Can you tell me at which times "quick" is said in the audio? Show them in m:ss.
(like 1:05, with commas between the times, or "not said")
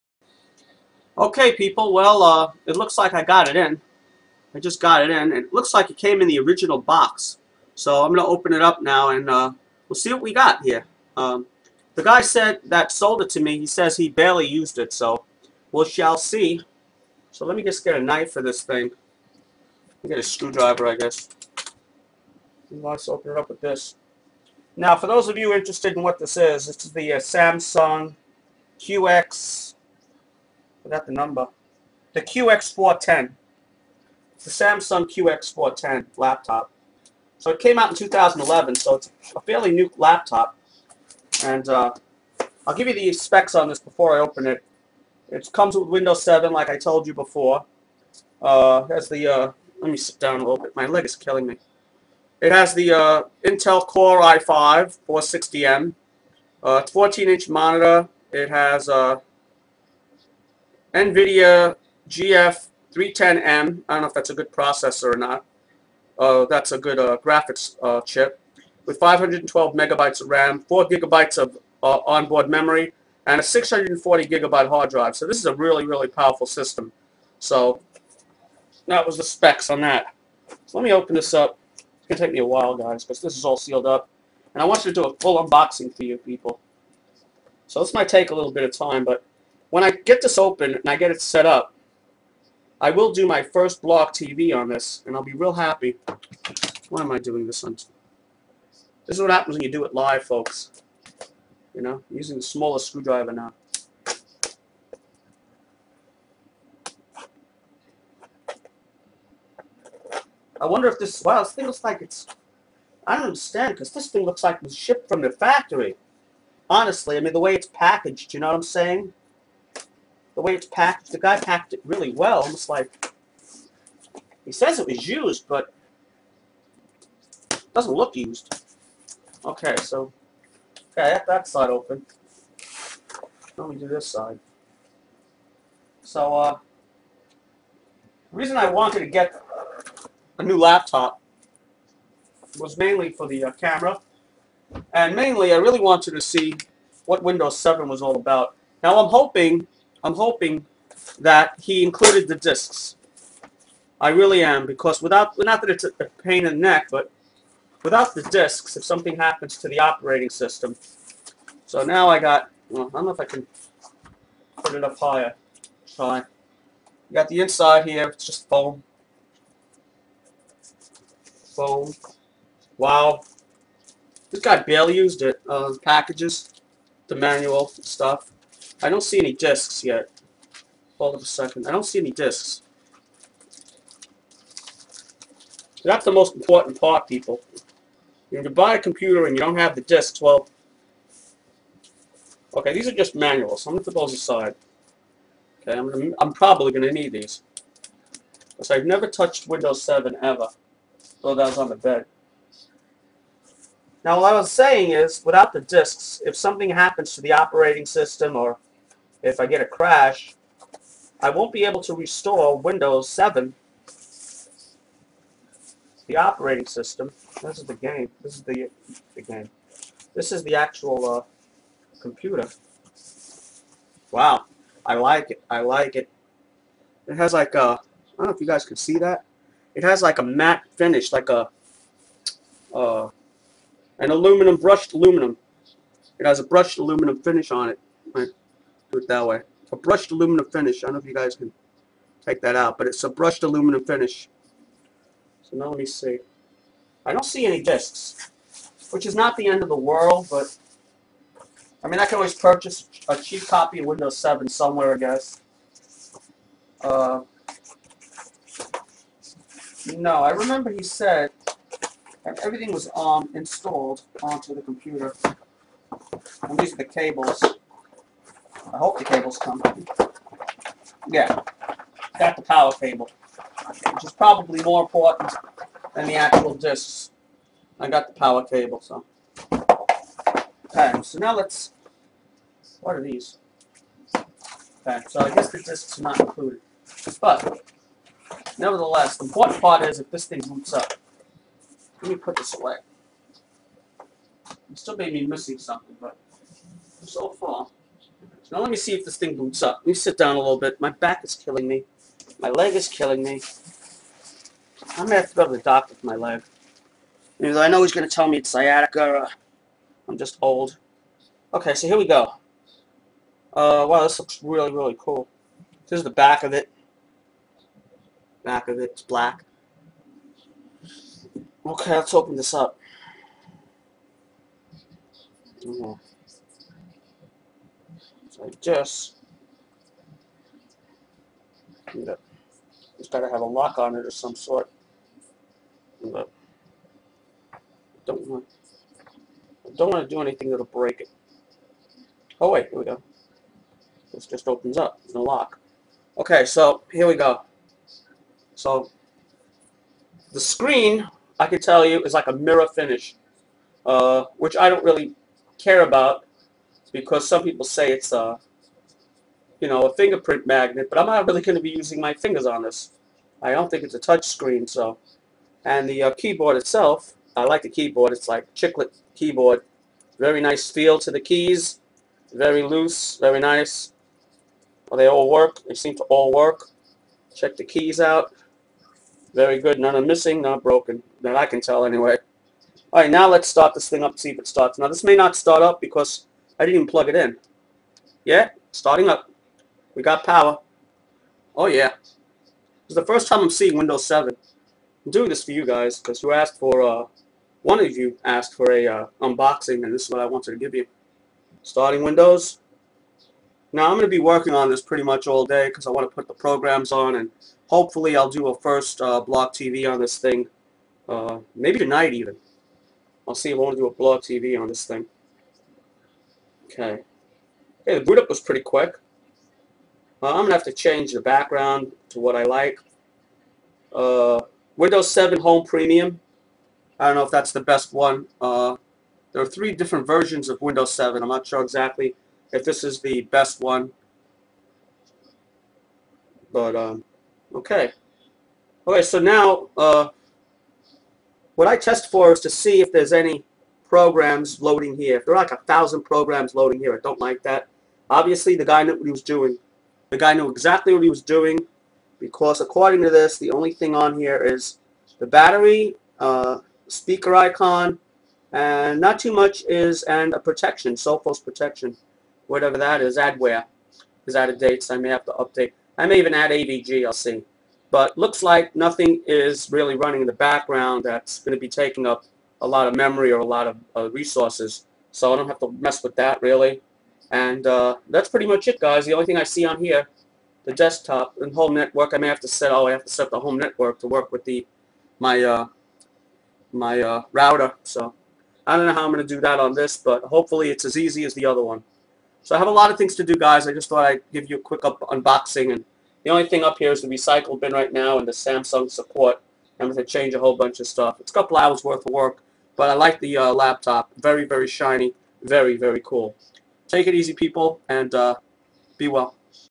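6:58, 8:14.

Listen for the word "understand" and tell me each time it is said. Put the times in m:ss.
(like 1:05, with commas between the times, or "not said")
1:53.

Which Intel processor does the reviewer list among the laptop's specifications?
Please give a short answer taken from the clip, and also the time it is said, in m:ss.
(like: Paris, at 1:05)
Core i5 460M, at 0:53.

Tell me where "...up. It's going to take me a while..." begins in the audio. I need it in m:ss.
1:21.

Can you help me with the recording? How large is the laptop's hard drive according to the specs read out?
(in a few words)
640 gigabytes.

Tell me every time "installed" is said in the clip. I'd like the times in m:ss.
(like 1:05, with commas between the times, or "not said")
4:23.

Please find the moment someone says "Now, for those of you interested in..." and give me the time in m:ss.
0:24.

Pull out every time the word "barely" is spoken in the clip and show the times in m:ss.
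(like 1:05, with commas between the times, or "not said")
0:14, 2:54.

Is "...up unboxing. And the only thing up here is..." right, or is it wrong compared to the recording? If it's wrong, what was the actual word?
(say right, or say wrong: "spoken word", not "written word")
right.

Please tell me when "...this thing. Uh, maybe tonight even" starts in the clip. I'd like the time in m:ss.
6:49.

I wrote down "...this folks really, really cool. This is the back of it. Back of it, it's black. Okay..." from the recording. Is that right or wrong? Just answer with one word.
wrong.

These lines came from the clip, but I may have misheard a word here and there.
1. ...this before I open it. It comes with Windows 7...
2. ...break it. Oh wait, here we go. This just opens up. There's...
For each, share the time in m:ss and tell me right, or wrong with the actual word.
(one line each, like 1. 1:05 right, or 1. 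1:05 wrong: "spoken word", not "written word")
1. 0:43 right
2. 5:40 right.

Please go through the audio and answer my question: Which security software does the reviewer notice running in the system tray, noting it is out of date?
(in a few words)
Sophos.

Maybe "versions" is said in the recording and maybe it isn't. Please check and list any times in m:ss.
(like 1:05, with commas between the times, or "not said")
7:10.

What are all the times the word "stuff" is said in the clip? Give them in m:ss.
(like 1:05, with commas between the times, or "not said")
2:57, 8:20.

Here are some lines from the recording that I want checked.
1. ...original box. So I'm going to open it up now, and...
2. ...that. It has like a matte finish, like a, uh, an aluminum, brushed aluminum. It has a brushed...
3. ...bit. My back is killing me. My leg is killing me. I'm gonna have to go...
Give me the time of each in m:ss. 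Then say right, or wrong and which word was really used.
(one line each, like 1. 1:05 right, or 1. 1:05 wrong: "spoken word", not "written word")
1. 0:06 right
2. 3:48 right
3. 5:00 right.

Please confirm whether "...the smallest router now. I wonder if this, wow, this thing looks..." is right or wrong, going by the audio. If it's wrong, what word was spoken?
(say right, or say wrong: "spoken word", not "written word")
wrong: "screwdriver", not "router".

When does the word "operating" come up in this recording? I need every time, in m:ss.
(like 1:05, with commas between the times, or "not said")
2:39, 3:27, 3:36.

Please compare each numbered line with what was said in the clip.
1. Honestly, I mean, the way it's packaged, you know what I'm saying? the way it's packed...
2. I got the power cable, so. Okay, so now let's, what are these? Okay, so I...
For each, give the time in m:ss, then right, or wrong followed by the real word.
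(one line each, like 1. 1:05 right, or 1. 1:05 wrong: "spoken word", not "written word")
1. 1:56 right
2. 4:37 right.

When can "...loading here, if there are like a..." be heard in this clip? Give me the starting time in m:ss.
7:24.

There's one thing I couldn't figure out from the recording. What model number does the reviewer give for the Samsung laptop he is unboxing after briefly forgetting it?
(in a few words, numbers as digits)
QX410.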